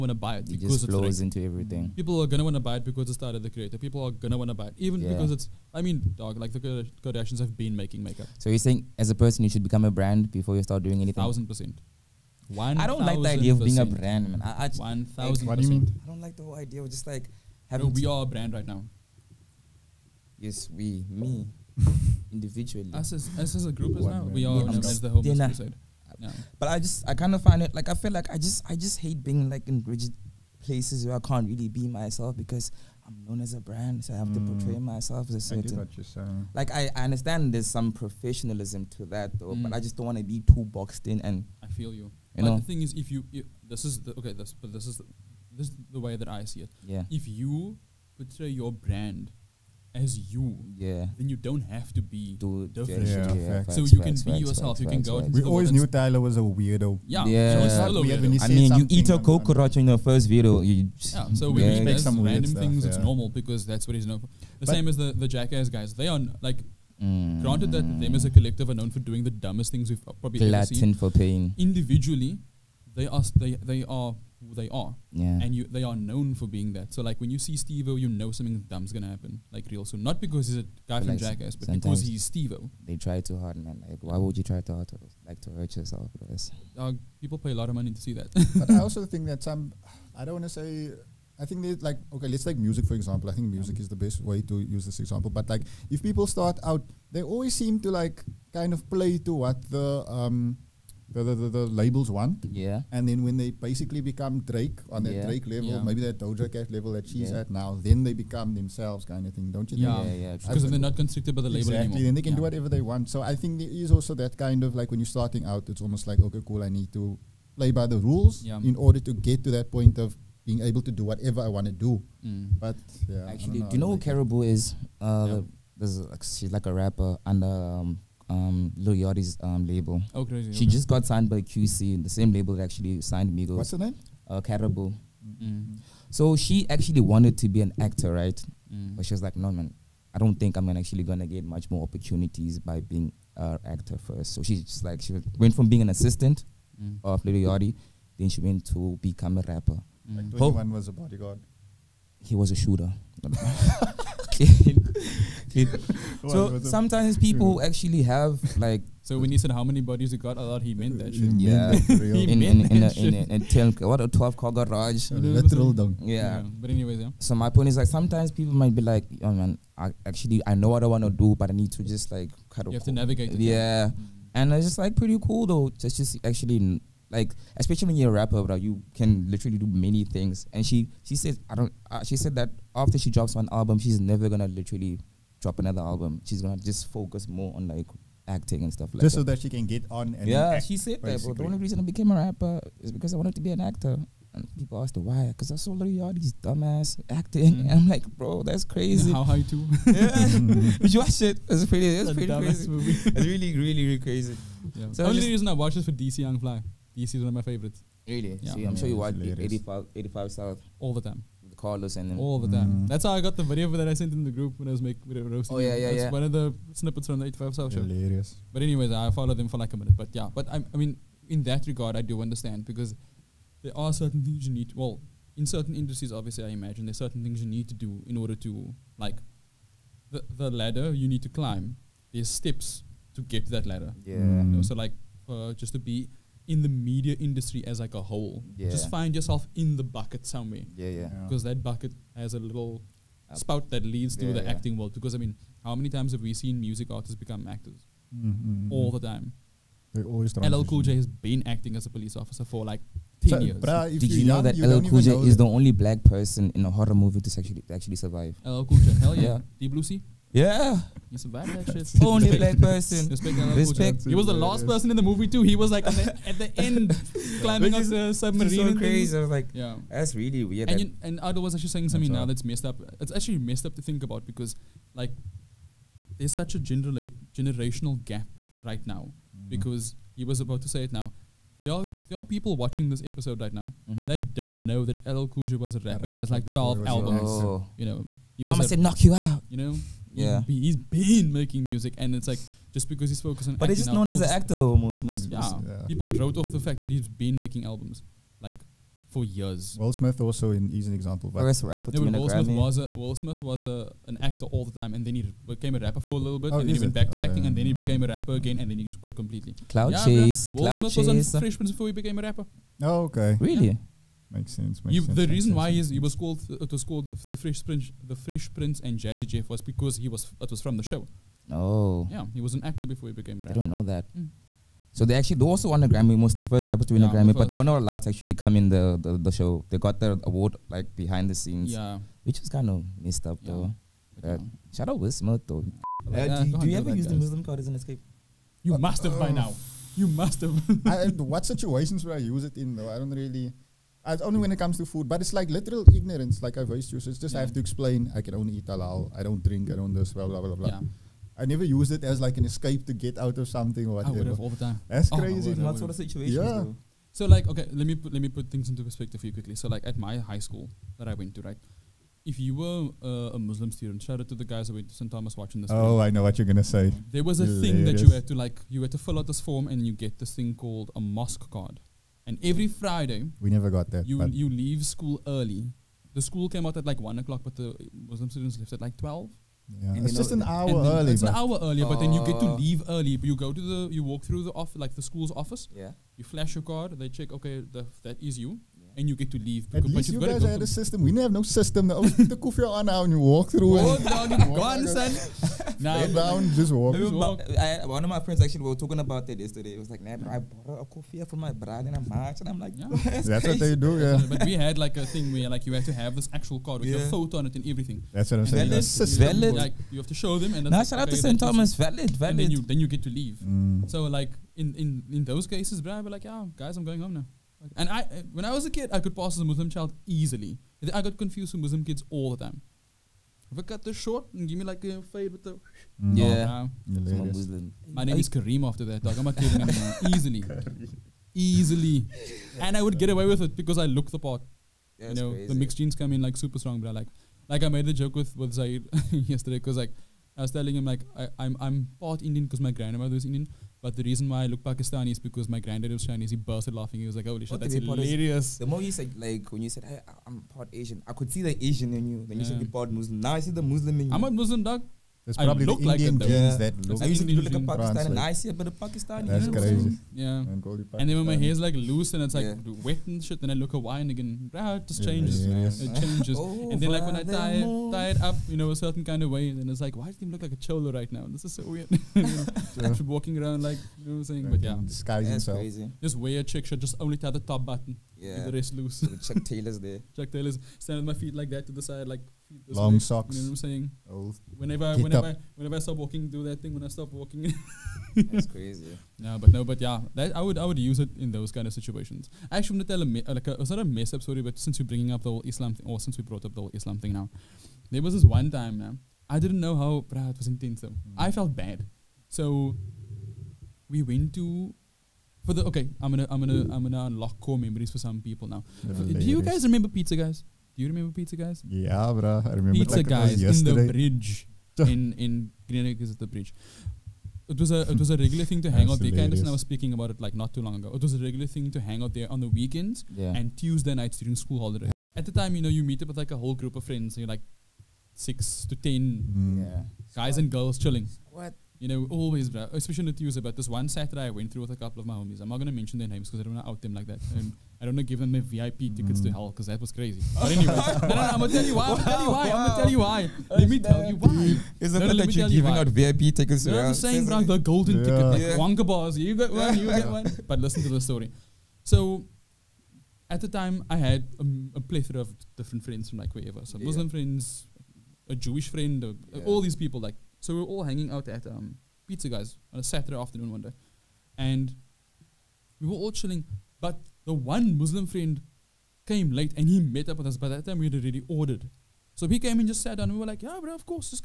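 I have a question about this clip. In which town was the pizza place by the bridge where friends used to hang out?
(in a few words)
Greenock.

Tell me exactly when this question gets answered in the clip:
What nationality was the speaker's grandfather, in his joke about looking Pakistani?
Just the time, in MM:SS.
07:26.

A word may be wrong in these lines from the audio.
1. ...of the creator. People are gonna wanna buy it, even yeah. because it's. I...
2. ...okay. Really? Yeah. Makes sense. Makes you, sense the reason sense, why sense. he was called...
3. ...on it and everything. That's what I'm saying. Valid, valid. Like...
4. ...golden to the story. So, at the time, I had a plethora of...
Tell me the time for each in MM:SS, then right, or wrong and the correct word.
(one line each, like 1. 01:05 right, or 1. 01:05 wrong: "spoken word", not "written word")
1. 00:03 right
2. 05:13 right
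3. 06:47 right
4. 09:10 wrong: "listen", not "golden".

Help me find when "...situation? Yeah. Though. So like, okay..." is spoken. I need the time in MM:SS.
05:55.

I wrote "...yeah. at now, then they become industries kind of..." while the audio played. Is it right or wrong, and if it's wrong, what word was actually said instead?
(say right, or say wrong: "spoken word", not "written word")
wrong: "themselves", not "industries".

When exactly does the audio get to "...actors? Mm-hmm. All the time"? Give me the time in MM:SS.
04:07.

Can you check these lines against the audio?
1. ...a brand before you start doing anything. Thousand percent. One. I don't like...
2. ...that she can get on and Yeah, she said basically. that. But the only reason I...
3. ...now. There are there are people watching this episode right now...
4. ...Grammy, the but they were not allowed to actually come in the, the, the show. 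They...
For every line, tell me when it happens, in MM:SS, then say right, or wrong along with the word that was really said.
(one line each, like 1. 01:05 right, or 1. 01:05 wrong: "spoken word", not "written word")
1. 00:09 right
2. 03:09 right
3. 04:40 right
4. 05:27 right.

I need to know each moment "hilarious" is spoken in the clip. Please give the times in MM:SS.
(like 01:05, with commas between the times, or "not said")
03:37, 06:07, 07:27.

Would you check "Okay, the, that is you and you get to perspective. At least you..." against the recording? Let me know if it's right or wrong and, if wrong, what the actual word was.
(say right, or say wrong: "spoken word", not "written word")
wrong: "leave", not "perspective".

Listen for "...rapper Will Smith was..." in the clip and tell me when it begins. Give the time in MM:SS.
05:01.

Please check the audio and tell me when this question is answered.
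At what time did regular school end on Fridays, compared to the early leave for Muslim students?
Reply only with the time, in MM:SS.
06:17.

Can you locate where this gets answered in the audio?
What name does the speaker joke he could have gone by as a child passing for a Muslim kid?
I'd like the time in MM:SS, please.
07:08.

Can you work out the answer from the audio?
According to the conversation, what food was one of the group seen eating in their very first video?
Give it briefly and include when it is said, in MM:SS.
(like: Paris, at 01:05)
coconut, at 00:59.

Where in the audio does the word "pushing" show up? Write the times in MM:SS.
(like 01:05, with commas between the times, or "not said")
not said.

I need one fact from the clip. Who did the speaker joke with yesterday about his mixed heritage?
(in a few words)
Zaid.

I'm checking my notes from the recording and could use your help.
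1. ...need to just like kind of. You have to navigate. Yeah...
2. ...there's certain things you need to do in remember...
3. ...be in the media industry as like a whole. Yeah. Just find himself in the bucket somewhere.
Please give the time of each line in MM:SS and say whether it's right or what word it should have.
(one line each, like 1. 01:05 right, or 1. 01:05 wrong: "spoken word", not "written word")
1. 02:51 right
2. 03:46 wrong: "order", not "remember"
3. 03:55 wrong: "yourself", not "himself".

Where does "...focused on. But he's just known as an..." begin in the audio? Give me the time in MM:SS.
04:53.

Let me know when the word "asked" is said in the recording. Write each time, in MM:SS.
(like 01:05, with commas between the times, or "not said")
03:14.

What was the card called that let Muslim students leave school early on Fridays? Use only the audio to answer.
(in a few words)
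mosque card.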